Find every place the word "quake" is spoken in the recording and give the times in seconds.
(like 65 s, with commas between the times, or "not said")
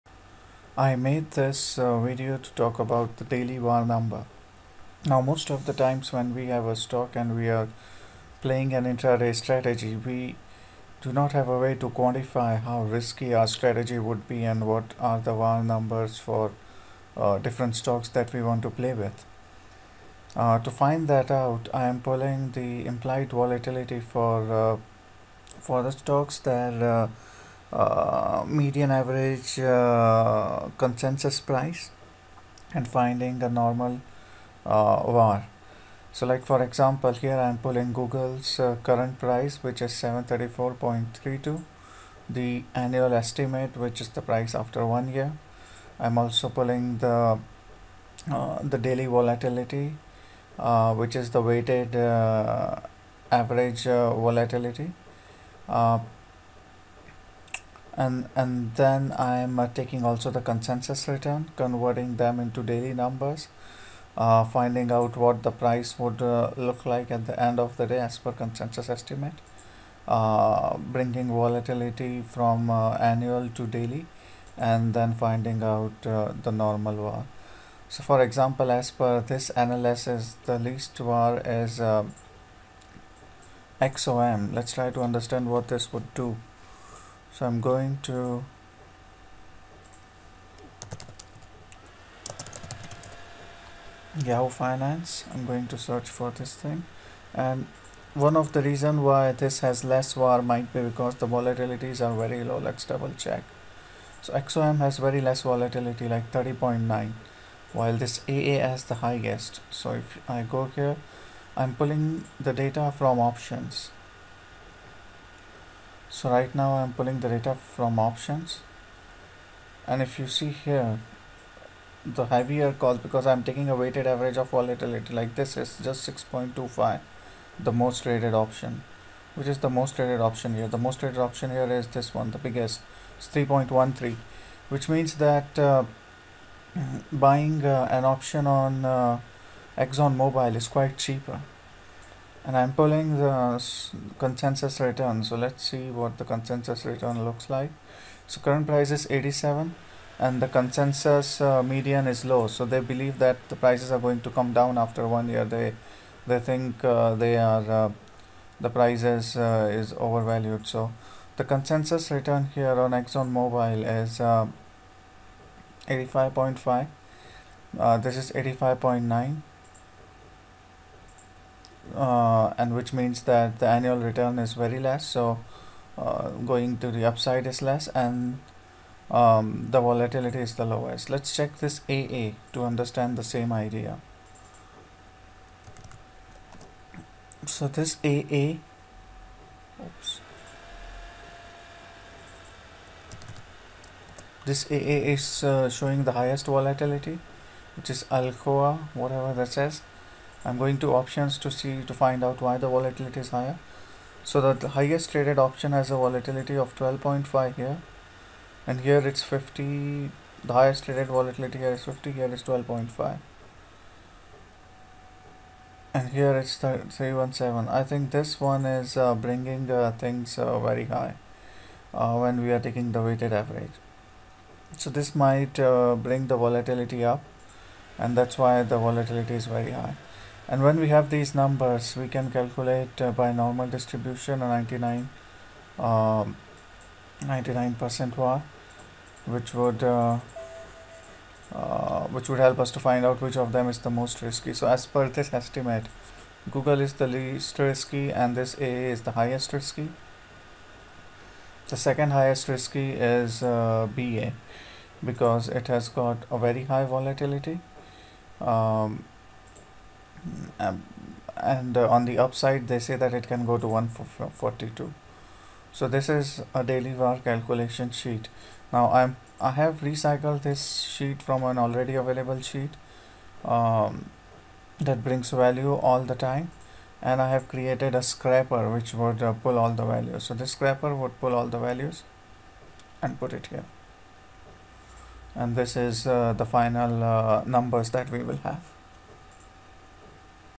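not said.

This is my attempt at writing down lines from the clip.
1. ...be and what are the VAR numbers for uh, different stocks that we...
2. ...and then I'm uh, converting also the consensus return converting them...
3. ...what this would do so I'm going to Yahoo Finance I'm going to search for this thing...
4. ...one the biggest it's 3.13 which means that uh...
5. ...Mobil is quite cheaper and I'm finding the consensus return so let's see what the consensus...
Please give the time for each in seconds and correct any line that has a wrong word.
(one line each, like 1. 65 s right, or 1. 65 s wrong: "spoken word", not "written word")
1. 14 s right
2. 58 s wrong: "taking", not "converting"
3. 85 s right
4. 132 s right
5. 140 s wrong: "pulling", not "finding".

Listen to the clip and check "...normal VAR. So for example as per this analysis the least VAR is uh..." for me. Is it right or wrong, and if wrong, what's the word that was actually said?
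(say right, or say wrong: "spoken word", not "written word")
right.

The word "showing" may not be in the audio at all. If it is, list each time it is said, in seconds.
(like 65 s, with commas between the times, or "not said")
195 s.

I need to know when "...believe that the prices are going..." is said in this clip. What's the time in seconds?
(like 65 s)
152 s.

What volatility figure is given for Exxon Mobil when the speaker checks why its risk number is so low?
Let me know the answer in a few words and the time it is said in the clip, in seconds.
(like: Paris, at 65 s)
30.9, at 106 s.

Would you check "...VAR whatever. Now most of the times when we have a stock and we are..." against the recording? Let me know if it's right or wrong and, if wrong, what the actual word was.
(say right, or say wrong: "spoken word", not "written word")
wrong: "number", not "whatever".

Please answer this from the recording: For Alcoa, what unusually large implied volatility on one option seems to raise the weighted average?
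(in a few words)
317.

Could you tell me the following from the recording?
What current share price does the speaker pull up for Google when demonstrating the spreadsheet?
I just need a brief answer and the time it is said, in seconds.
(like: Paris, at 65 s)
734.32, at 39 s.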